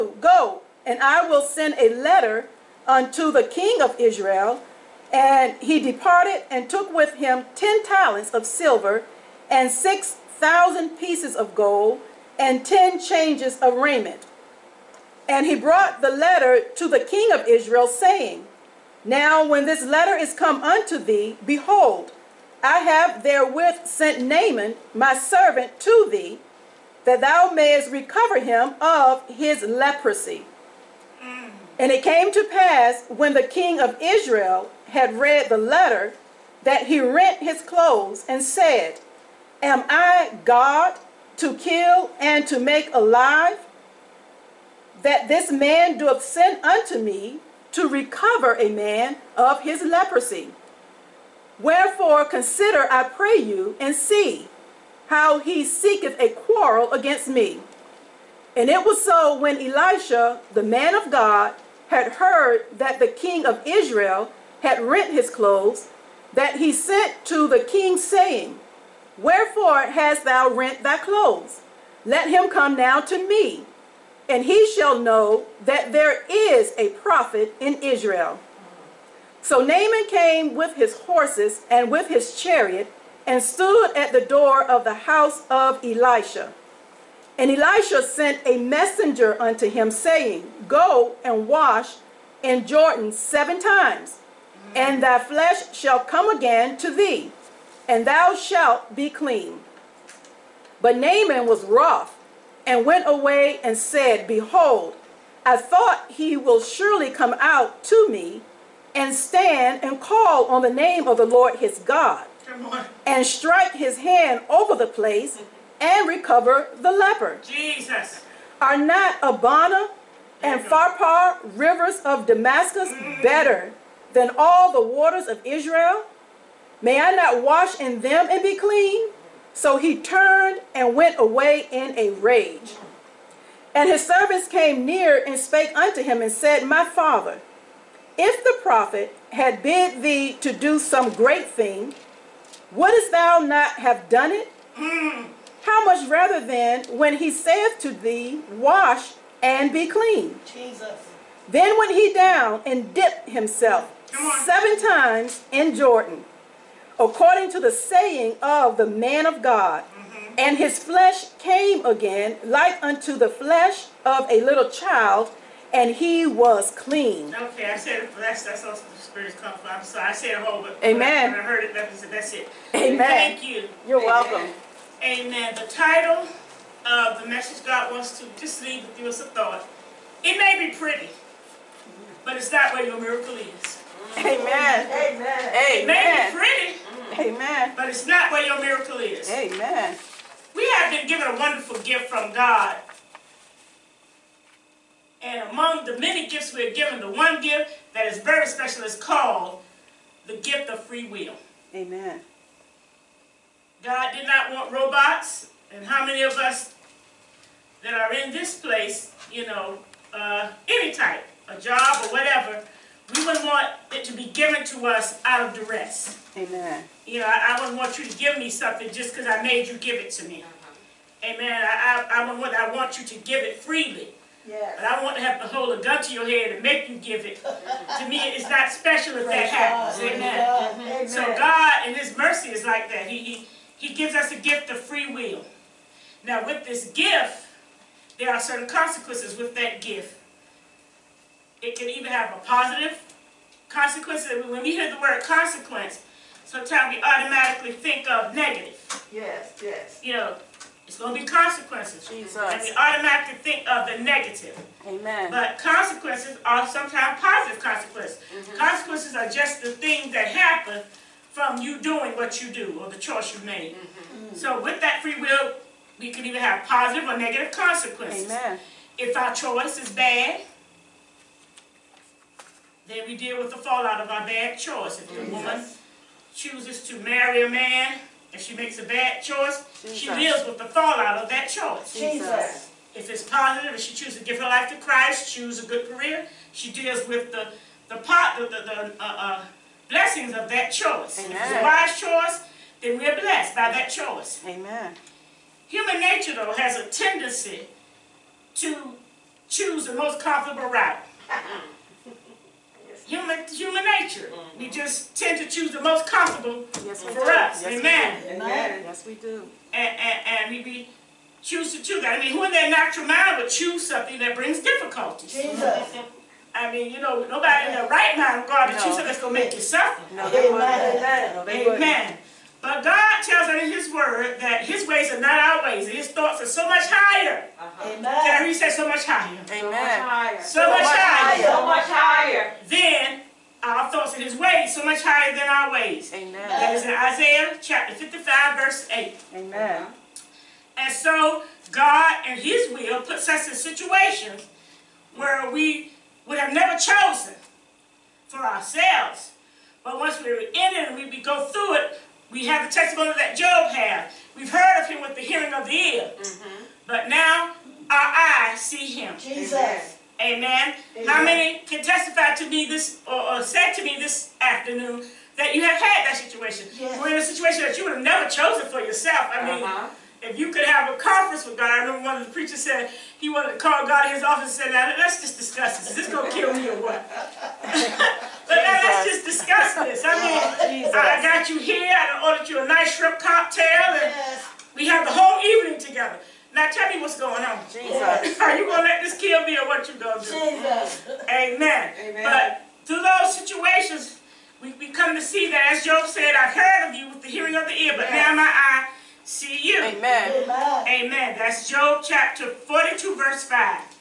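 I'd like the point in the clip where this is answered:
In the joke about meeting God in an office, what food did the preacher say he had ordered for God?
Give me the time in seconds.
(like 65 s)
382 s.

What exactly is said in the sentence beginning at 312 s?
I mean, who in their natural mind would choose something that brings difficulties?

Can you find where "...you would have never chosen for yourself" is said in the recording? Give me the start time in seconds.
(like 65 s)
367 s.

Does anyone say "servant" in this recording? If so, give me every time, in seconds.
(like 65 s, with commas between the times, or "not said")
25 s, 134 s.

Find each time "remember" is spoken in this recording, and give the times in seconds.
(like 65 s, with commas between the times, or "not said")
371 s.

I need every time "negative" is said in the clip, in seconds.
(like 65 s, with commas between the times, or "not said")
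248 s, 254 s, 267 s.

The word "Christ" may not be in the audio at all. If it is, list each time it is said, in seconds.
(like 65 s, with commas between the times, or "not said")
284 s.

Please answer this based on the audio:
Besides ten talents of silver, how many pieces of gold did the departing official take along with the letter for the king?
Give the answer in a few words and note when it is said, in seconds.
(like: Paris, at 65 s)
6000, at 9 s.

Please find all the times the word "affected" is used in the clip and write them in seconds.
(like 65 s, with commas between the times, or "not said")
not said.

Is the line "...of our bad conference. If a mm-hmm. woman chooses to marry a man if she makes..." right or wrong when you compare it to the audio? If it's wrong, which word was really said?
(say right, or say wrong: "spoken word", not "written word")
wrong: "choice", not "conference".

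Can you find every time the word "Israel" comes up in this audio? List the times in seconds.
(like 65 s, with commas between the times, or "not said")
3 s, 17 s, 34 s, 63 s, 77 s, 125 s.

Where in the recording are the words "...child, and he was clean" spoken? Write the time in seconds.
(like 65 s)
164 s.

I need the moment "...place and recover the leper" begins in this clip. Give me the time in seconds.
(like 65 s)
114 s.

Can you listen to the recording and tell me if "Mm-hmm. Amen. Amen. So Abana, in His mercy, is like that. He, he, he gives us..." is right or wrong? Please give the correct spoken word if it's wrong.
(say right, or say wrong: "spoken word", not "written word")
wrong: "God", not "Abana".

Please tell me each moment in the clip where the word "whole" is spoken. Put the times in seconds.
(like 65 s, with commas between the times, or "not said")
170 s, 385 s.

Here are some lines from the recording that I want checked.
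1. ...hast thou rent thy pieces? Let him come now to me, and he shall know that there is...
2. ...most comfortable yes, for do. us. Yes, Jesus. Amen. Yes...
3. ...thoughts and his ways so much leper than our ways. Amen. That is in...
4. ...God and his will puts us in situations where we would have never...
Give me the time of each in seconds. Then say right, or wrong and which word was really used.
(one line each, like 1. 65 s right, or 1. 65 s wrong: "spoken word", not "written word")
1. 69 s wrong: "clothes", not "pieces"
2. 305 s wrong: "Amen", not "Jesus"
3. 333 s wrong: "higher", not "leper"
4. 341 s right.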